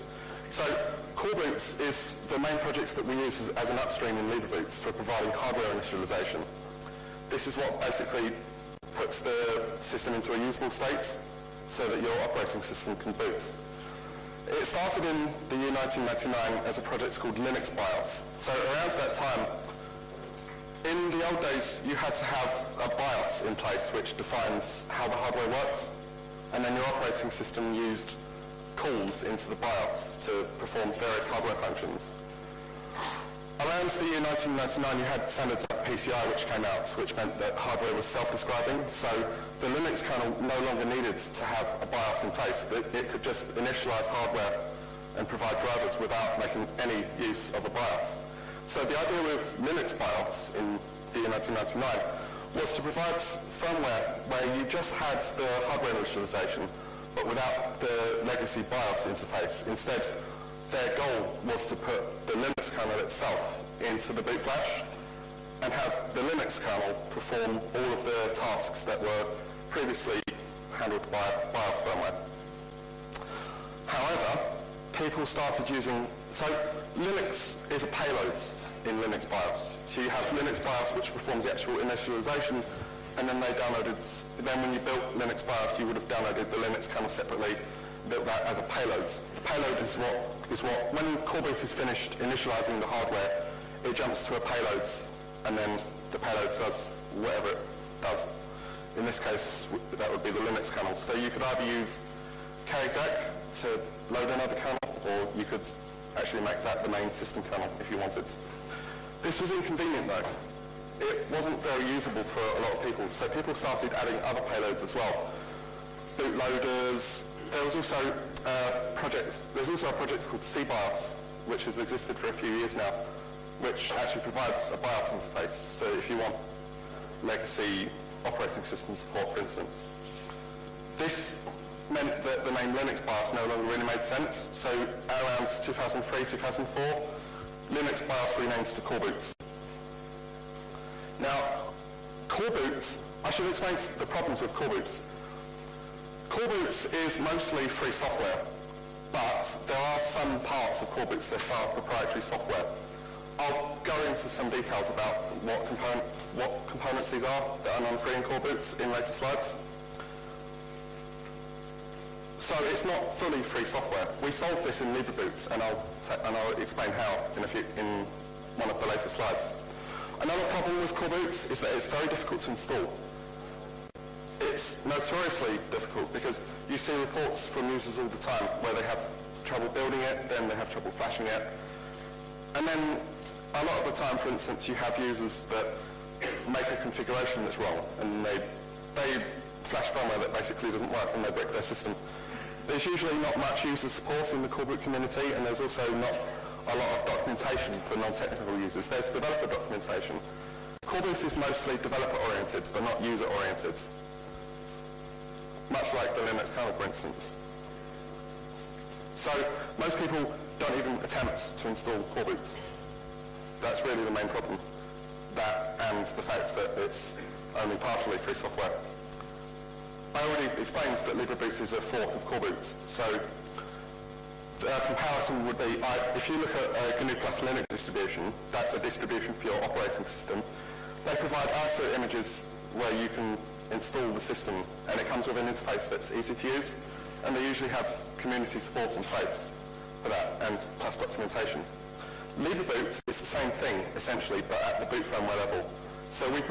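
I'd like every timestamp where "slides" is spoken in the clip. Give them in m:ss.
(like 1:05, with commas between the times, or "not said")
2:39, 2:49.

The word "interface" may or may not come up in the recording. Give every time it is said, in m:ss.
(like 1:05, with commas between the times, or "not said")
0:59, 2:05, 3:55.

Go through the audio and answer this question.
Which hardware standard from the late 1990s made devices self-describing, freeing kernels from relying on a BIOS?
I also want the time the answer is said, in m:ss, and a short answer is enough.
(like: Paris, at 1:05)
PCI, at 0:35.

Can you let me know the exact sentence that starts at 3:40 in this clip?
I already explained that LibreBoot is a fork of Coreboot.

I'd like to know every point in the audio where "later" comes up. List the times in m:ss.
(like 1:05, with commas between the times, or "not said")
2:38, 2:48.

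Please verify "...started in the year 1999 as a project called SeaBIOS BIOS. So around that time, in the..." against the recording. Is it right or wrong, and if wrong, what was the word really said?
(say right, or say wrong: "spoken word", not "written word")
wrong: "Linux", not "SeaBIOS".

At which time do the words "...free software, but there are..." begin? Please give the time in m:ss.
2:27.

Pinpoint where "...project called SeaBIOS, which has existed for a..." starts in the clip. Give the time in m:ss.
1:59.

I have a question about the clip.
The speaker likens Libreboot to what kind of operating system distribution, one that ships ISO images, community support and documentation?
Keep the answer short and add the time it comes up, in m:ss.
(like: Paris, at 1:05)
GNU plus Linux, at 3:46.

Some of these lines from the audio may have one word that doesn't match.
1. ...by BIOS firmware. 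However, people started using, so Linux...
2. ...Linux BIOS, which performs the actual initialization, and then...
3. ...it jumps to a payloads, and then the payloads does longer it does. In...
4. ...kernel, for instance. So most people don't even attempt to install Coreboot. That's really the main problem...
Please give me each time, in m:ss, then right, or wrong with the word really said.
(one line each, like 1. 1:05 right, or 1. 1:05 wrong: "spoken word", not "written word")
1. 1:11 right
2. 1:20 right
3. 1:33 wrong: "whatever", not "longer"
4. 3:26 right.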